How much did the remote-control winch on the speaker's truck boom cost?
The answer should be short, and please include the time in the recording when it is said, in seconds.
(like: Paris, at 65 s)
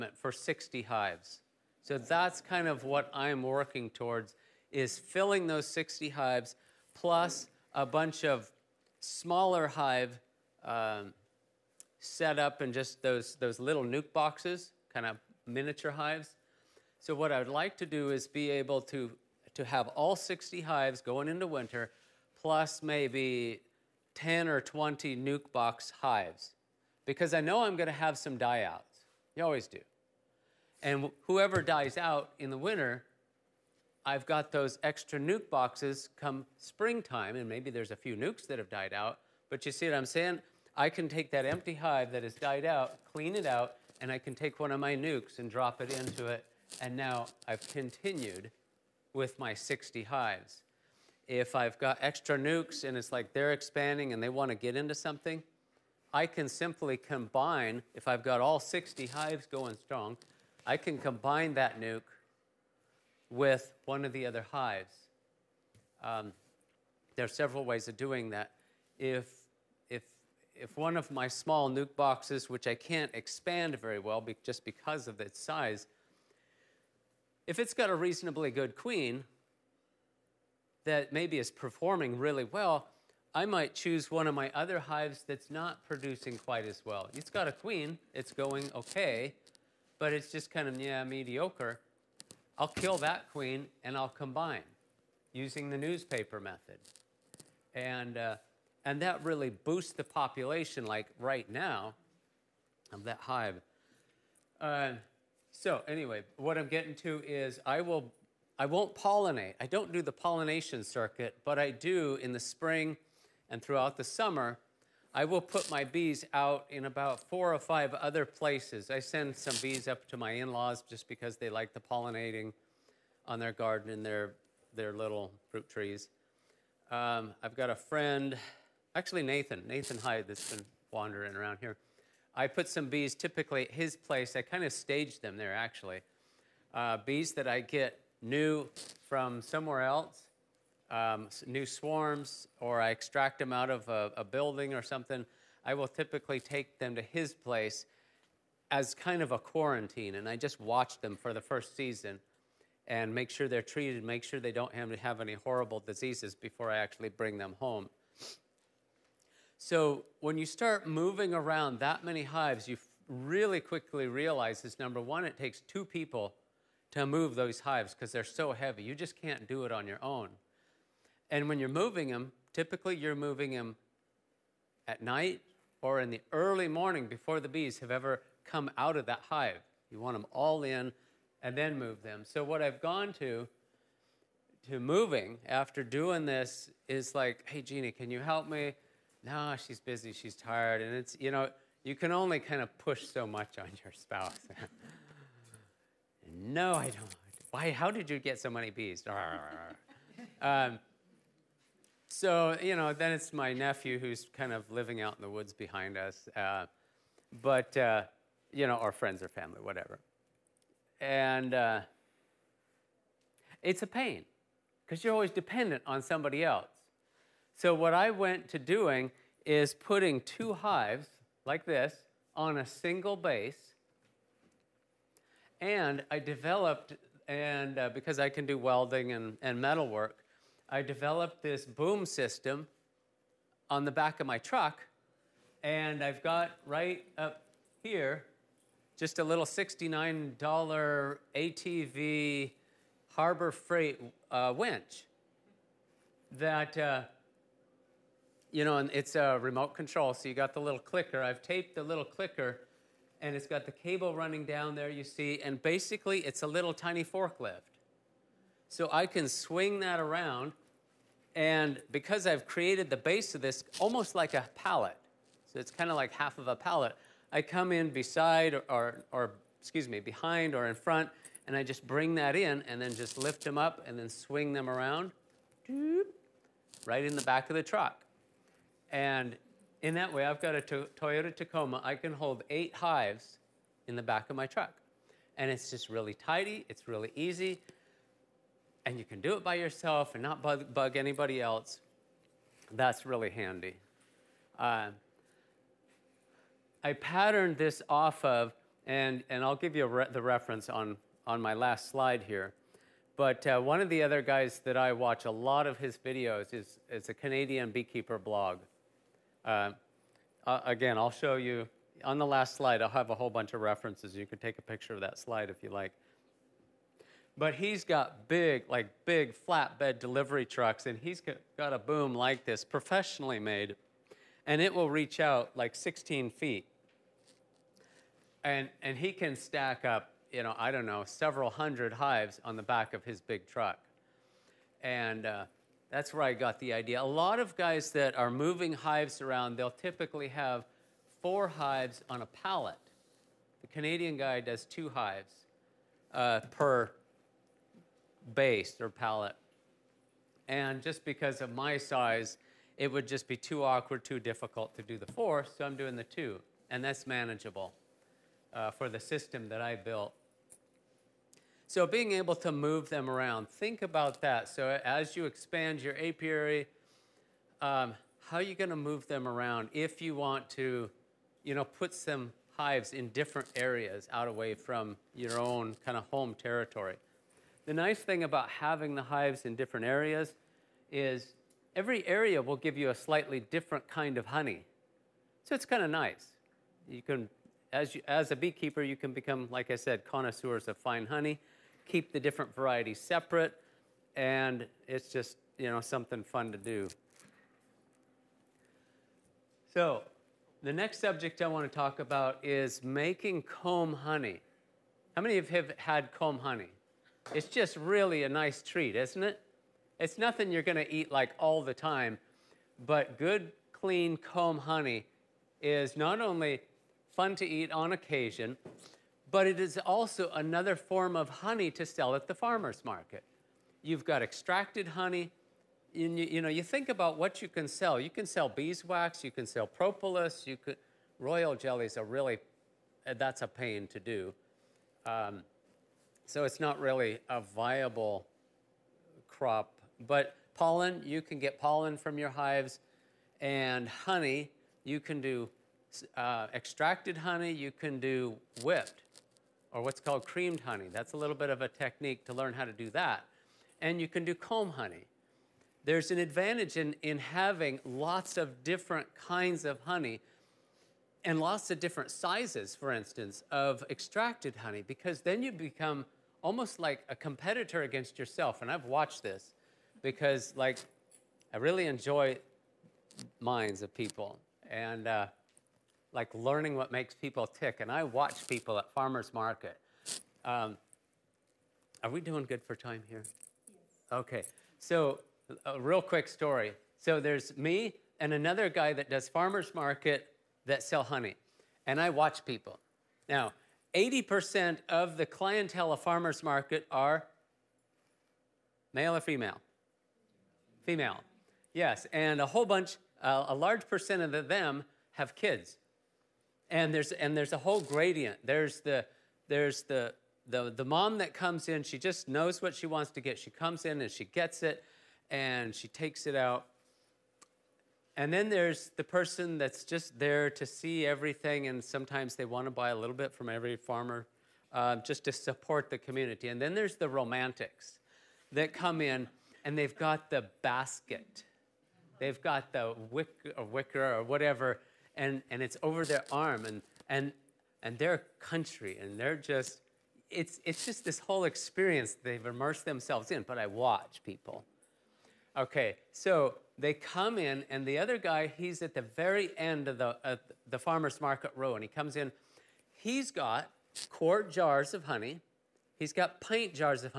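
$69, at 239 s.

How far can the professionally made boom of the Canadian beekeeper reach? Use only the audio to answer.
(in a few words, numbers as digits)
16 feet.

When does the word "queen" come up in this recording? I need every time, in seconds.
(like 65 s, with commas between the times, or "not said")
78 s, 87 s, 93 s.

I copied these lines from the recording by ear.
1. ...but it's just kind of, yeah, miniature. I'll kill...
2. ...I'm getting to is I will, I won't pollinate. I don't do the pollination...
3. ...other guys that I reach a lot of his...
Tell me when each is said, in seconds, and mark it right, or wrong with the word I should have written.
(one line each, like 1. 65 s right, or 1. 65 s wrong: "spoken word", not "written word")
1. 89 s wrong: "mediocre", not "miniature"
2. 106 s right
3. 304 s wrong: "watch", not "reach".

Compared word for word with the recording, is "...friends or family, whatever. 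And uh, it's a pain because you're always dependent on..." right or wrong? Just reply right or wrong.
right.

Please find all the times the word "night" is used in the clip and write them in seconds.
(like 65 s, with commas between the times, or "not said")
174 s.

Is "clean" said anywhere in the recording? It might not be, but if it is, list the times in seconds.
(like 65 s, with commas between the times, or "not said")
43 s, 413 s.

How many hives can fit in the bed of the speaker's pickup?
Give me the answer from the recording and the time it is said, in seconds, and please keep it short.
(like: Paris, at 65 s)
8, at 282 s.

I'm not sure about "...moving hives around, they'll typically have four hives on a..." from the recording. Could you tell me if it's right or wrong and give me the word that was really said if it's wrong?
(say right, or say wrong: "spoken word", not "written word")
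right.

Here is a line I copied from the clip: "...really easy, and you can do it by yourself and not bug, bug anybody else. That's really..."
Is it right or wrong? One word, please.
right.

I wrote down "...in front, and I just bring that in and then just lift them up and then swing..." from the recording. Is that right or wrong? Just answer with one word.
right.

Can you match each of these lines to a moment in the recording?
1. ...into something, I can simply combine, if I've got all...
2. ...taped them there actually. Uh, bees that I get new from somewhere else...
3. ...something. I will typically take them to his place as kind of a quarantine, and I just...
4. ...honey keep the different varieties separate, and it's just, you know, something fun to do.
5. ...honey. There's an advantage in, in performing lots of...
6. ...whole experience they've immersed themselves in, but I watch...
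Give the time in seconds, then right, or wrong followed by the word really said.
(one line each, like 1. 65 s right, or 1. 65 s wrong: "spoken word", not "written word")
1. 54 s right
2. 134 s wrong: "staged", not "taped"
3. 144 s right
4. 391 s right
5. 454 s wrong: "having", not "performing"
6. 541 s right.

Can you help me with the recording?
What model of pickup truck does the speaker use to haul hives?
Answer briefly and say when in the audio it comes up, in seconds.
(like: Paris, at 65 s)
Toyota Tacoma, at 280 s.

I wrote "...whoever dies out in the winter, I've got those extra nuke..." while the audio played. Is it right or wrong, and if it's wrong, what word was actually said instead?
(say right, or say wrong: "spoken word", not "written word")
right.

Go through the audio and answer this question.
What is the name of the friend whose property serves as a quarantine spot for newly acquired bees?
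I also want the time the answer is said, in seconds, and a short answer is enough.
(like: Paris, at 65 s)
Nathan Hyde, at 129 s.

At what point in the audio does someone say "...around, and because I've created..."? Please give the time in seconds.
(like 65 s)
259 s.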